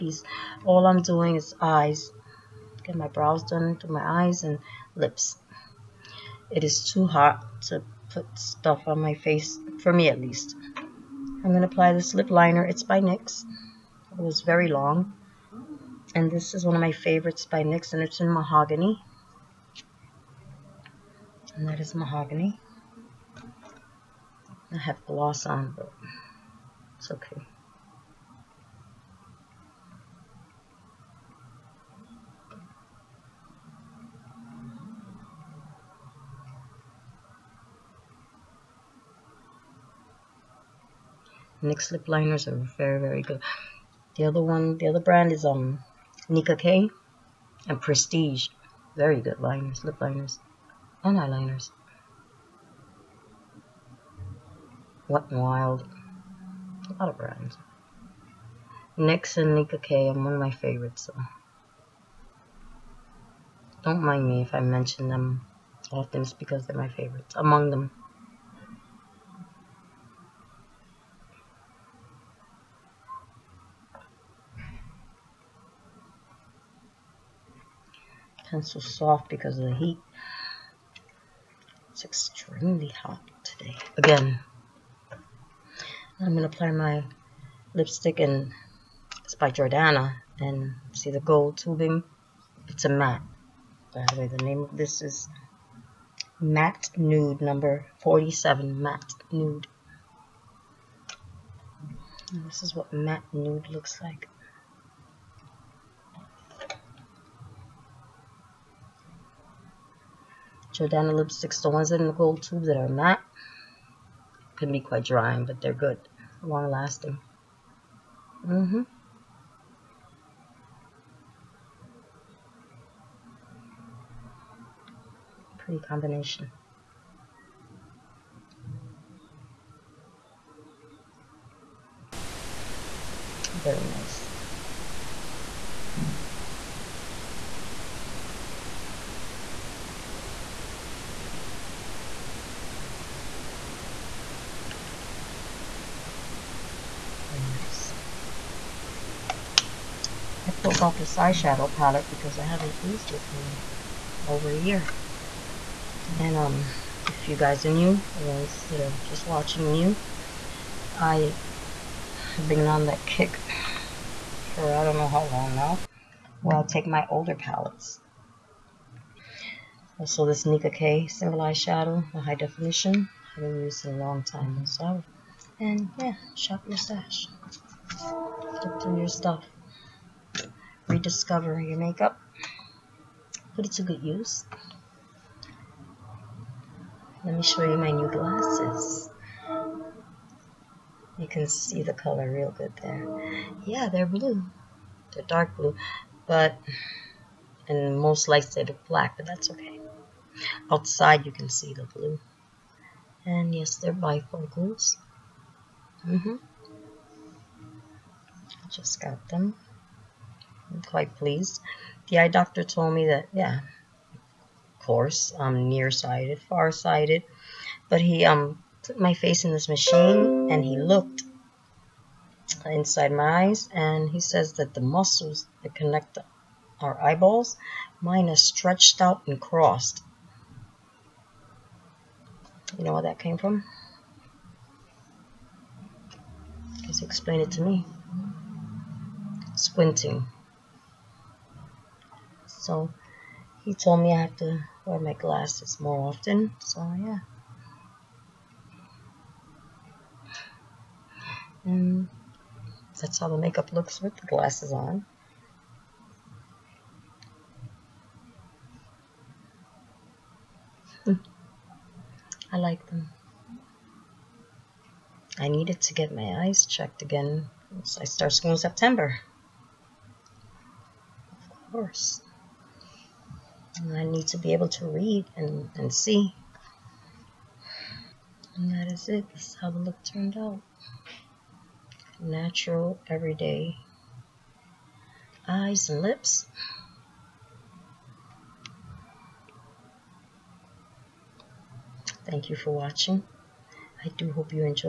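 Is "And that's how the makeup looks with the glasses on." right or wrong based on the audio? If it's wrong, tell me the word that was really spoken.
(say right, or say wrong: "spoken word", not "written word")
right.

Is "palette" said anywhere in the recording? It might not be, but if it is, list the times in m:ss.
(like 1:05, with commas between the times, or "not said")
2:31, 2:47.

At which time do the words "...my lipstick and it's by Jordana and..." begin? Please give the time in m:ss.
1:26.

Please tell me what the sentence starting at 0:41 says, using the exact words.
NYX lip liners are very, very good.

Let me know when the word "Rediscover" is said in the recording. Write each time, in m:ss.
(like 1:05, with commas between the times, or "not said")
3:00.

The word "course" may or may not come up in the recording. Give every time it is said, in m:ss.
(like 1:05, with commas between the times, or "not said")
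3:34, 4:31.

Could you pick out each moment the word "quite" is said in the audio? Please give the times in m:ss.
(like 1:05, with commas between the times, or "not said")
1:54, 3:30.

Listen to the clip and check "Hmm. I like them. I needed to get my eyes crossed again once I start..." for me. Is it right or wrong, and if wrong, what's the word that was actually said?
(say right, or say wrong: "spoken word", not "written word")
wrong: "checked", not "crossed".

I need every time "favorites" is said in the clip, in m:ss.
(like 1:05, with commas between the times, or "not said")
0:16, 1:00, 1:06.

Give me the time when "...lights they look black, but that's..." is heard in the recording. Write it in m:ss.
3:18.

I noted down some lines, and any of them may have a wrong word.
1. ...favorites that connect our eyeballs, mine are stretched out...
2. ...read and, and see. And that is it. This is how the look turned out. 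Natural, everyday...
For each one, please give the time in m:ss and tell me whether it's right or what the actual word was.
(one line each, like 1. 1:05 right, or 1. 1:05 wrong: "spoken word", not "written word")
1. 3:44 wrong: "muscles", not "favorites"
2. 4:34 right.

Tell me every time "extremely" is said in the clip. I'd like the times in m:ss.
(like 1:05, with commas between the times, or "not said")
1:22.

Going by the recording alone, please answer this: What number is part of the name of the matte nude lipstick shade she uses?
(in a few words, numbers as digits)
47.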